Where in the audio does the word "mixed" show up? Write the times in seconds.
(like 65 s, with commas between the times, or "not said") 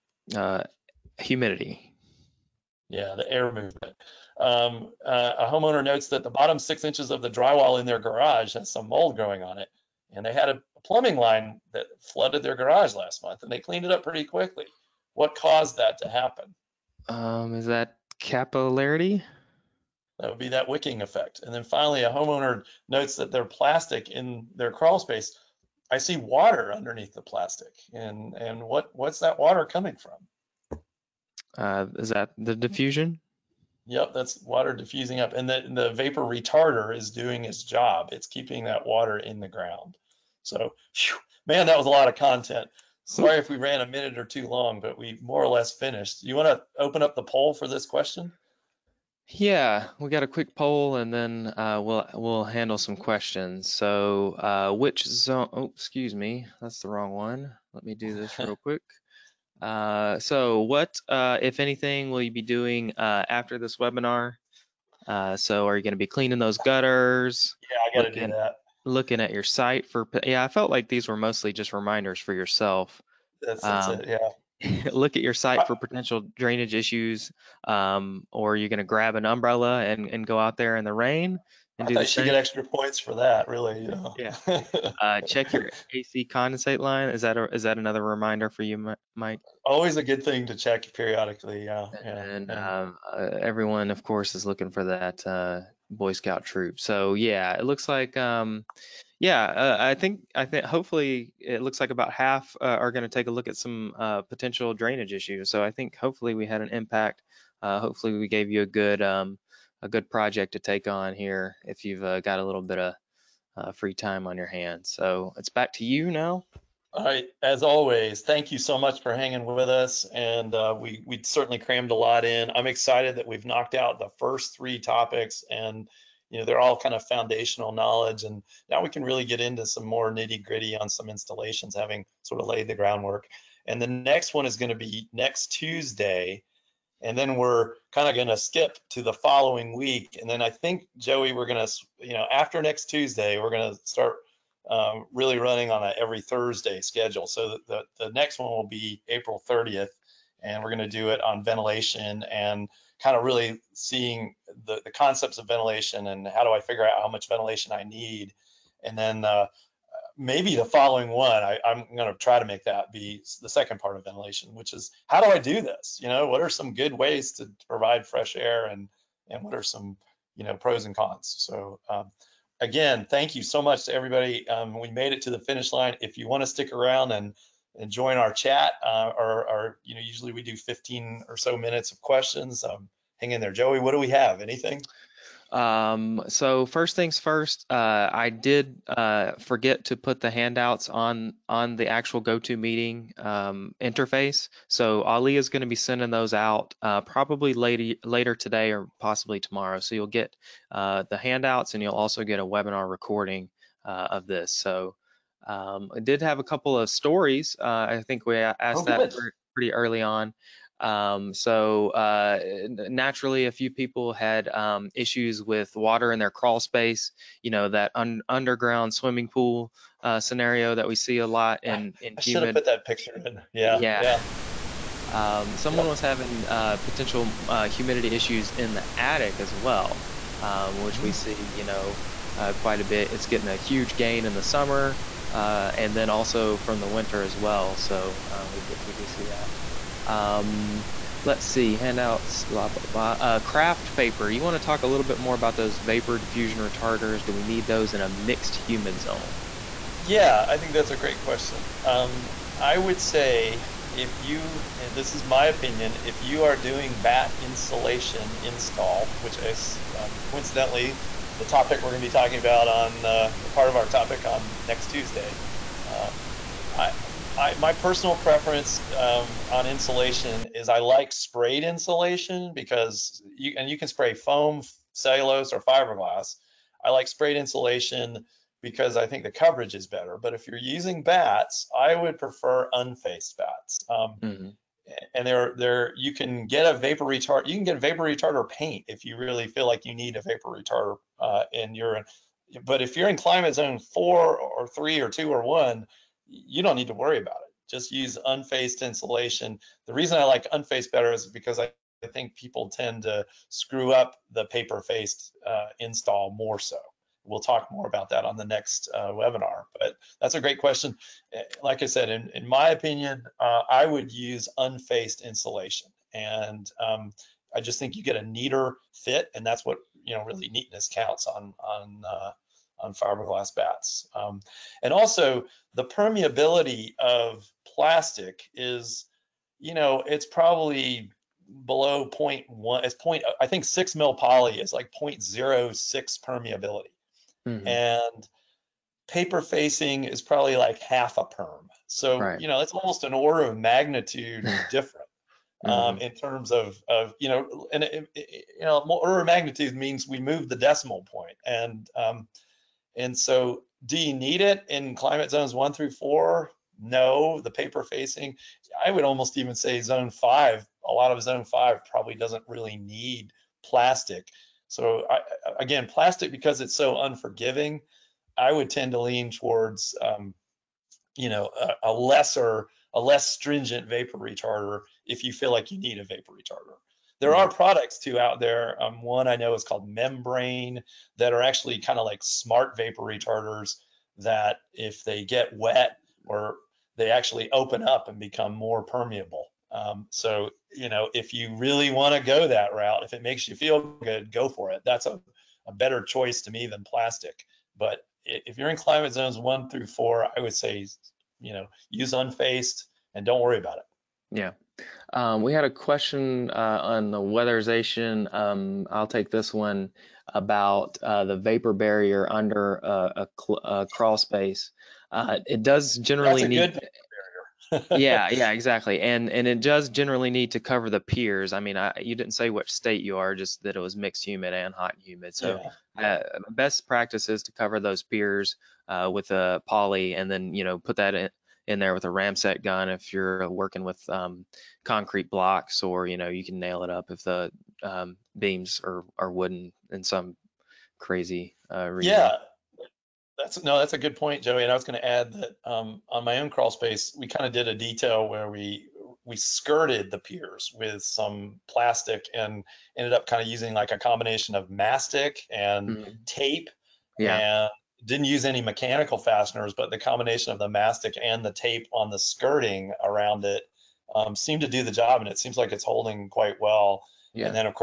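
248 s, 423 s.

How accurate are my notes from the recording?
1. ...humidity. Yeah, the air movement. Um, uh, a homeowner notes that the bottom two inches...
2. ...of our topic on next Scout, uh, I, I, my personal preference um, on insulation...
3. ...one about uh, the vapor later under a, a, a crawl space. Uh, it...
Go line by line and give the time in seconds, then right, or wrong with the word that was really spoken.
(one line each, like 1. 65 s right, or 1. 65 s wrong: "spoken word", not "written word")
1. 1 s wrong: "six", not "two"
2. 263 s wrong: "Tuesday", not "Scout"
3. 409 s wrong: "barrier", not "later".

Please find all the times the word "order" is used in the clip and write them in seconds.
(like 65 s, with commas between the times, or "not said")
343 s, 348 s.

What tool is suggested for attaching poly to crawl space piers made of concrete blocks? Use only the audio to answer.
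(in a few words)
ramset gun.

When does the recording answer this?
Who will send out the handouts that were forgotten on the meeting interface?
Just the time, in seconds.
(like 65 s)
195 s.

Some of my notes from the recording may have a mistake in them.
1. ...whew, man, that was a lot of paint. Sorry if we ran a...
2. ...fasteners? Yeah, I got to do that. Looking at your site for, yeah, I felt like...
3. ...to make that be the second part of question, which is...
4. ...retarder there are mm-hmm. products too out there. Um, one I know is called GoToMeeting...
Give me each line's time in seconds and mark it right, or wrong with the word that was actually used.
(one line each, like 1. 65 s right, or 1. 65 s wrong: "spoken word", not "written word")
1. 40 s wrong: "content", not "paint"
2. 66 s wrong: "gutters", not "fasteners"
3. 162 s wrong: "ventilation", not "question"
4. 376 s wrong: "MemBrain", not "GoToMeeting".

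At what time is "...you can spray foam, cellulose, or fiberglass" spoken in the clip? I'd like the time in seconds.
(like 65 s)
273 s.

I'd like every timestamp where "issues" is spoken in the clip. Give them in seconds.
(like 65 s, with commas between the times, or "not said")
76 s, 105 s, 214 s, 228 s.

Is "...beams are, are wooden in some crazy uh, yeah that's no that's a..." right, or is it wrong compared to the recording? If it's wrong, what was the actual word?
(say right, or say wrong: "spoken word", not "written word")
right.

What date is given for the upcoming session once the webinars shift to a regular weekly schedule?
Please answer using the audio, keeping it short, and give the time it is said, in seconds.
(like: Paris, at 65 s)
April 30th, at 149 s.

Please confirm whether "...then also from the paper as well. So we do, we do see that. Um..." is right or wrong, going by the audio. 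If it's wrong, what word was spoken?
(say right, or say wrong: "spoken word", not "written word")
wrong: "winter", not "paper".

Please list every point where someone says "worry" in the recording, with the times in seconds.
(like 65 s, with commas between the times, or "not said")
296 s, 403 s.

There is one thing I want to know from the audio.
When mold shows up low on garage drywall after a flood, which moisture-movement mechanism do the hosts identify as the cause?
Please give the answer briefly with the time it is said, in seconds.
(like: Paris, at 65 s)
capillarity, at 18 s.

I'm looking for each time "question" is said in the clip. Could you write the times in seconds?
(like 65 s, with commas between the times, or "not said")
47 s, 52 s, 182 s, 251 s, 310 s, 405 s.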